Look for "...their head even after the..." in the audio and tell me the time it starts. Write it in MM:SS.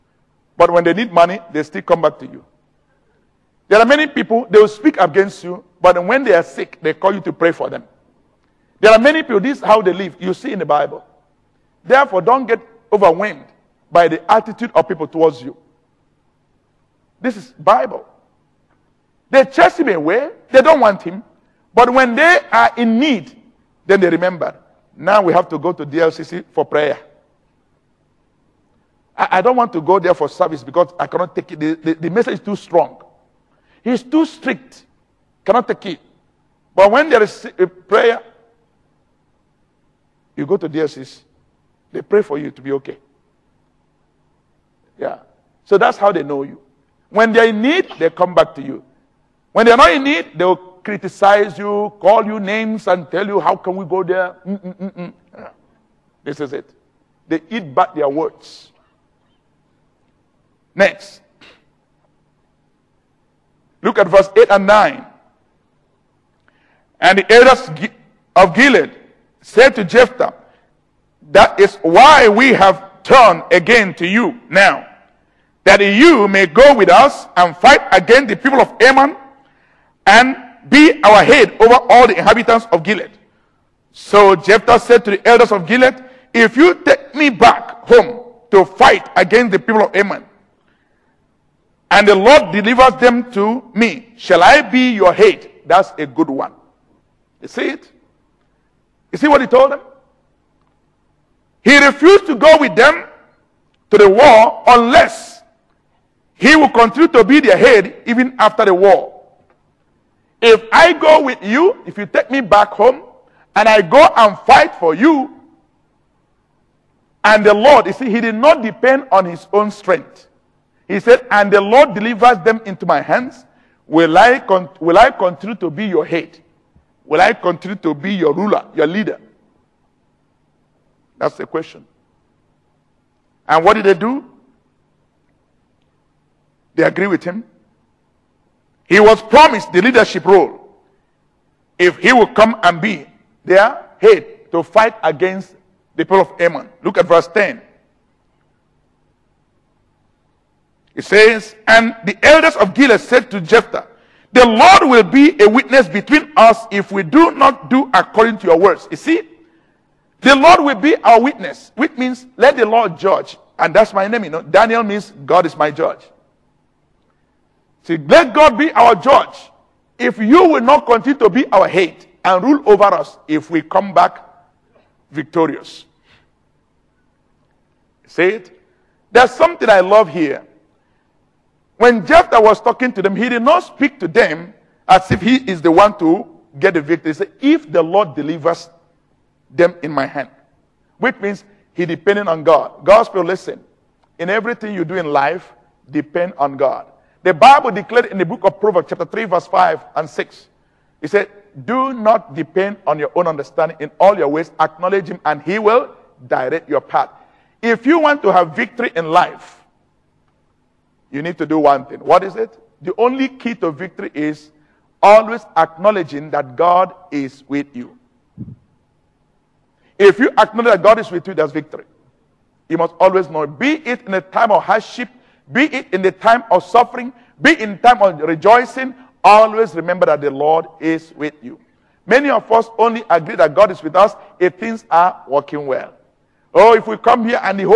01:47.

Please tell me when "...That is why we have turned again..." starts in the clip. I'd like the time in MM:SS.
01:11.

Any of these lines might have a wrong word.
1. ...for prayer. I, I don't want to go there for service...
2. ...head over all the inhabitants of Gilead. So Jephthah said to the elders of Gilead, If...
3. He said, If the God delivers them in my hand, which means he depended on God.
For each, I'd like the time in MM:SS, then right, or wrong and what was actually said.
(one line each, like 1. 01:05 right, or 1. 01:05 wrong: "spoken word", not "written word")
1. 00:26 right
2. 01:21 right
3. 03:07 wrong: "Lord", not "God".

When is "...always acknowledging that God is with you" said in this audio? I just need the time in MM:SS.
03:35.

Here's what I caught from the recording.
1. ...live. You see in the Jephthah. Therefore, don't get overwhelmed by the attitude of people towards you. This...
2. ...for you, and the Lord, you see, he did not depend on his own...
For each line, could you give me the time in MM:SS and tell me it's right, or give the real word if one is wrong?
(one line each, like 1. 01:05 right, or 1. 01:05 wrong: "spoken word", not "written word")
1. 00:09 wrong: "Bible", not "Jephthah"
2. 01:54 right.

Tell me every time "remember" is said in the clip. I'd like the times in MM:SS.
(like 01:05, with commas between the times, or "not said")
00:24, 03:49.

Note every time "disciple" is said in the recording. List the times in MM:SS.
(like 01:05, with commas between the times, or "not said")
not said.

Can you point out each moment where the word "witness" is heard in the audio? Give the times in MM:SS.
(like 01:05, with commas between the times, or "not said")
02:35, 02:41.